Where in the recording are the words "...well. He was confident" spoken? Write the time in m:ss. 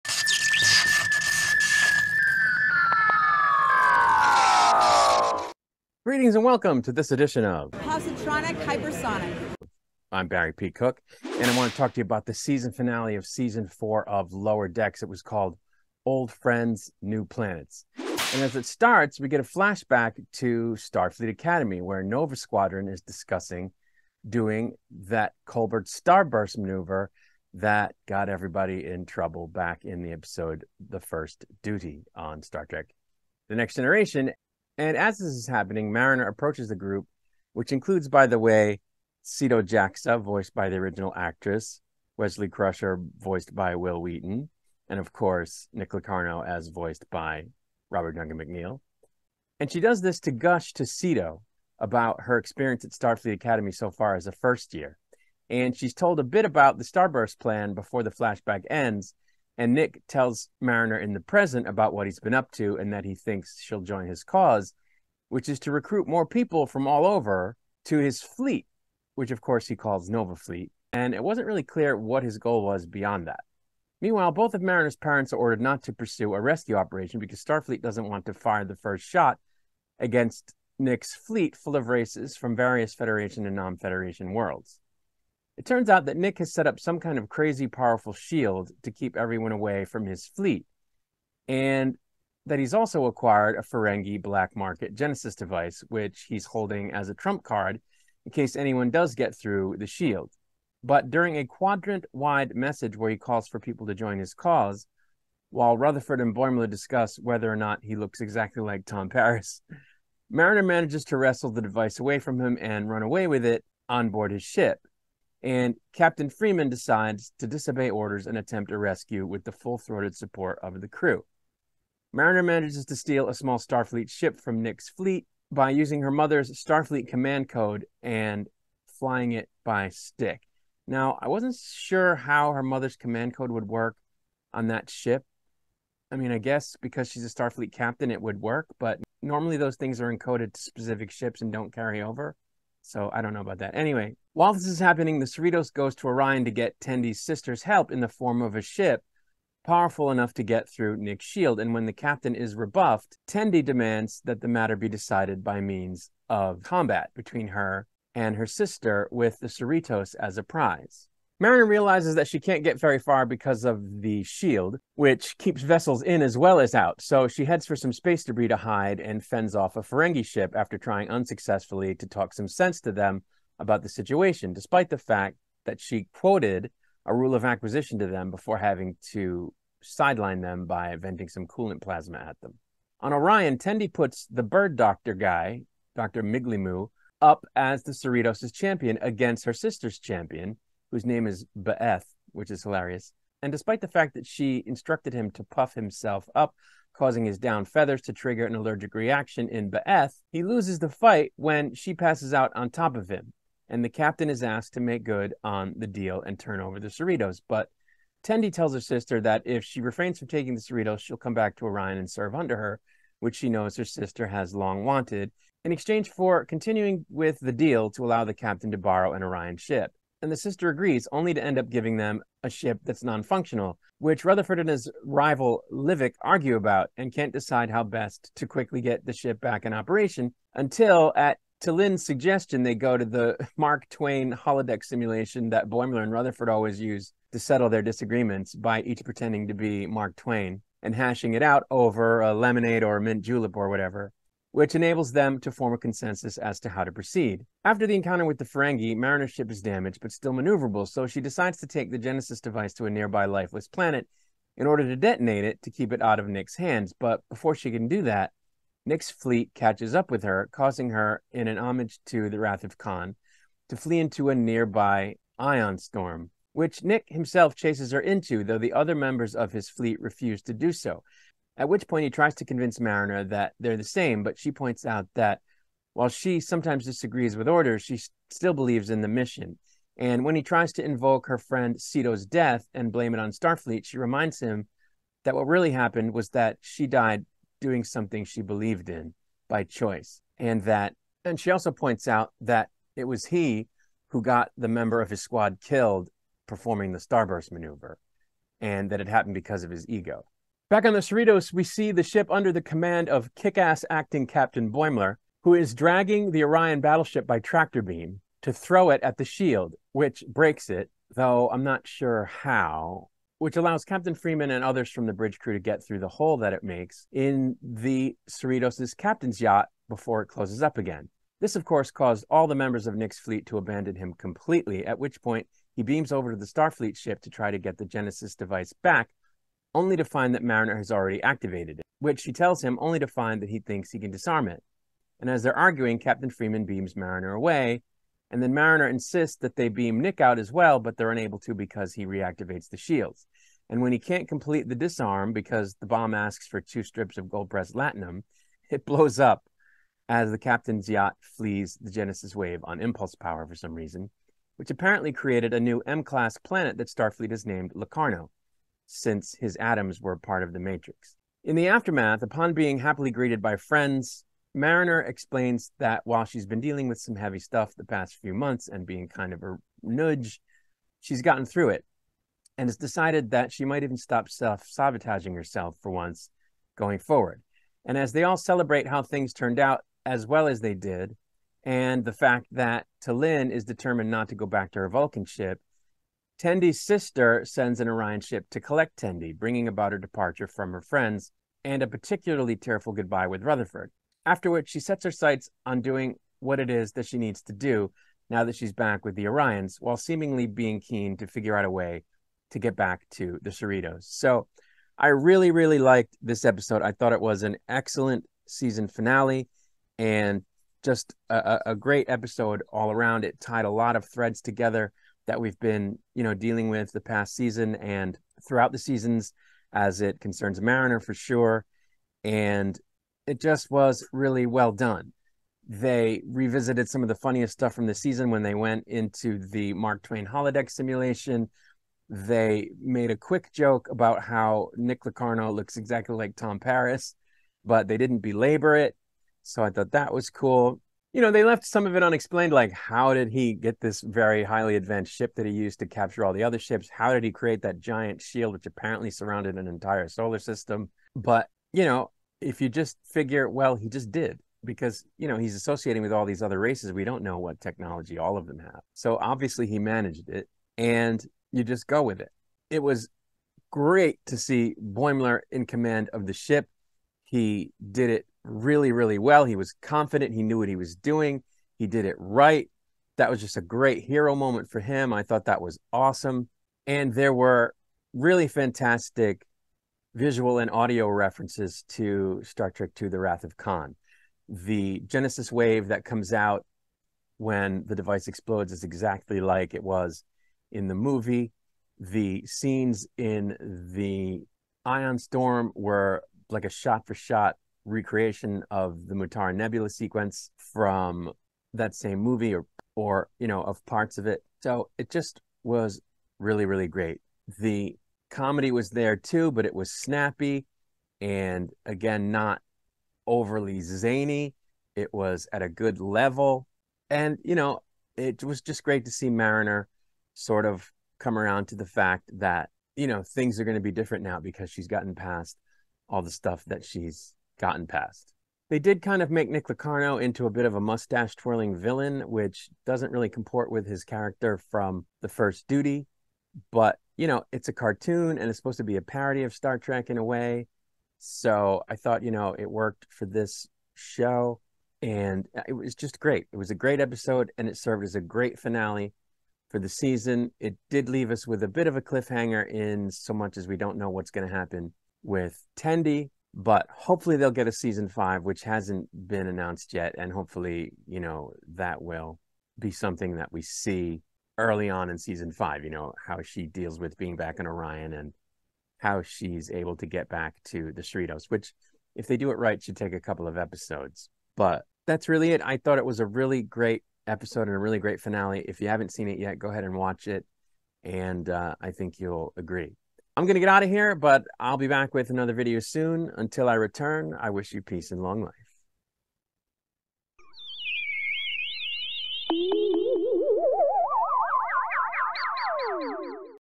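7:49.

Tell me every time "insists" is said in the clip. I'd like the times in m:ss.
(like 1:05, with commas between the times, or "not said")
5:38.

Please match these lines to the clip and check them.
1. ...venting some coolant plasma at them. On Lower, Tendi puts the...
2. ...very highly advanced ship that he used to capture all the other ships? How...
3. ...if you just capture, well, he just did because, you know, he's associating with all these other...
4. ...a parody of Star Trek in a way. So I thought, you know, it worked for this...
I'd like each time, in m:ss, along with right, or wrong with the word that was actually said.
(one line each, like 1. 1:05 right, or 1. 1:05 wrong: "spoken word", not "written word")
1. 3:00 wrong: "Orion", not "Lower"
2. 7:24 right
3. 7:32 wrong: "figure", not "capture"
4. 8:58 right.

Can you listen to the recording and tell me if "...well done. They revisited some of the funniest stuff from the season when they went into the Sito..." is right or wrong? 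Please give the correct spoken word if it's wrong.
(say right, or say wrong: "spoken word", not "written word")
wrong: "Mark", not "Sito".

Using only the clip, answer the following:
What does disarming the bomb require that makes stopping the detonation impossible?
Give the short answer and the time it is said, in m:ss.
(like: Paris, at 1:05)
Two strips of gold pressed latinum, at 5:46.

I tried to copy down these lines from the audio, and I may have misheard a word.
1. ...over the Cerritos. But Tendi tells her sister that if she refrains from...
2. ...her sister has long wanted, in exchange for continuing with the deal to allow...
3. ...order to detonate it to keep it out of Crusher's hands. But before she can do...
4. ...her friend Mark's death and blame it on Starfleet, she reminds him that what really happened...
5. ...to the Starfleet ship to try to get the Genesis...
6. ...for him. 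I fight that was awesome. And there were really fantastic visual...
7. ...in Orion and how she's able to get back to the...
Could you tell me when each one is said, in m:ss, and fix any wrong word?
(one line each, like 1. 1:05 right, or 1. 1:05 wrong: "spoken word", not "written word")
1. 3:26 right
2. 3:33 right
3. 4:14 wrong: "Nick", not "Crusher"
4. 4:41 wrong: "Sito", not "Mark"
5. 5:26 right
6. 7:54 wrong: "thought", not "fight"
7. 9:27 right.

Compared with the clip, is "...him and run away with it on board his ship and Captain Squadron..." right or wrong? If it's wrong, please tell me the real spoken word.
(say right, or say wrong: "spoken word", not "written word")
wrong: "Freeman", not "Squadron".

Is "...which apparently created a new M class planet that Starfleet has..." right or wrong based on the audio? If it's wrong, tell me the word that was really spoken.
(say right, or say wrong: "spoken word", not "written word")
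right.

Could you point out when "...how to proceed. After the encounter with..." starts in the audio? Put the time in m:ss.
4:06.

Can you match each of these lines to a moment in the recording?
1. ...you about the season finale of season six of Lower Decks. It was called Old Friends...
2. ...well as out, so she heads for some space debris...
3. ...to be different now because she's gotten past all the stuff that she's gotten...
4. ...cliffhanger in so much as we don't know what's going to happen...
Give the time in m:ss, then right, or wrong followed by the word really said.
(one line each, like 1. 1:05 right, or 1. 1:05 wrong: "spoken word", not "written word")
1. 0:12 wrong: "four", not "six"
2. 2:46 right
3. 8:43 right
4. 9:12 right.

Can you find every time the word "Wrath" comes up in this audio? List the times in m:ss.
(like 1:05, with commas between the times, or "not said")
4:22, 8:03.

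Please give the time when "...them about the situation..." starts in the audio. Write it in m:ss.
2:52.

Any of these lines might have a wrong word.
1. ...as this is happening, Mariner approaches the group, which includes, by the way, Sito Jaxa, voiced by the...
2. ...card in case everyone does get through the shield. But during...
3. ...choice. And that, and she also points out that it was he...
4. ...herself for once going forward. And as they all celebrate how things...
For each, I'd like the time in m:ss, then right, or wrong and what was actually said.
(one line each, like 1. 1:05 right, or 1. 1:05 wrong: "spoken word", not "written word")
1. 0:34 right
2. 1:37 wrong: "anyone", not "everyone"
3. 4:49 right
4. 6:15 right.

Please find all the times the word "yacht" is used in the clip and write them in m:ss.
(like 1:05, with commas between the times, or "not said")
5:19, 5:50.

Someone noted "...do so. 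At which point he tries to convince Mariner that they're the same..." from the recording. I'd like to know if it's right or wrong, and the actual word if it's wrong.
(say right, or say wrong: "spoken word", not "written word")
right.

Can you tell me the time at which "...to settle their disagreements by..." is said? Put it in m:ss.
3:57.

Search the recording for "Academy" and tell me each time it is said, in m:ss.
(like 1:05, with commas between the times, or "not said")
0:21, 0:53.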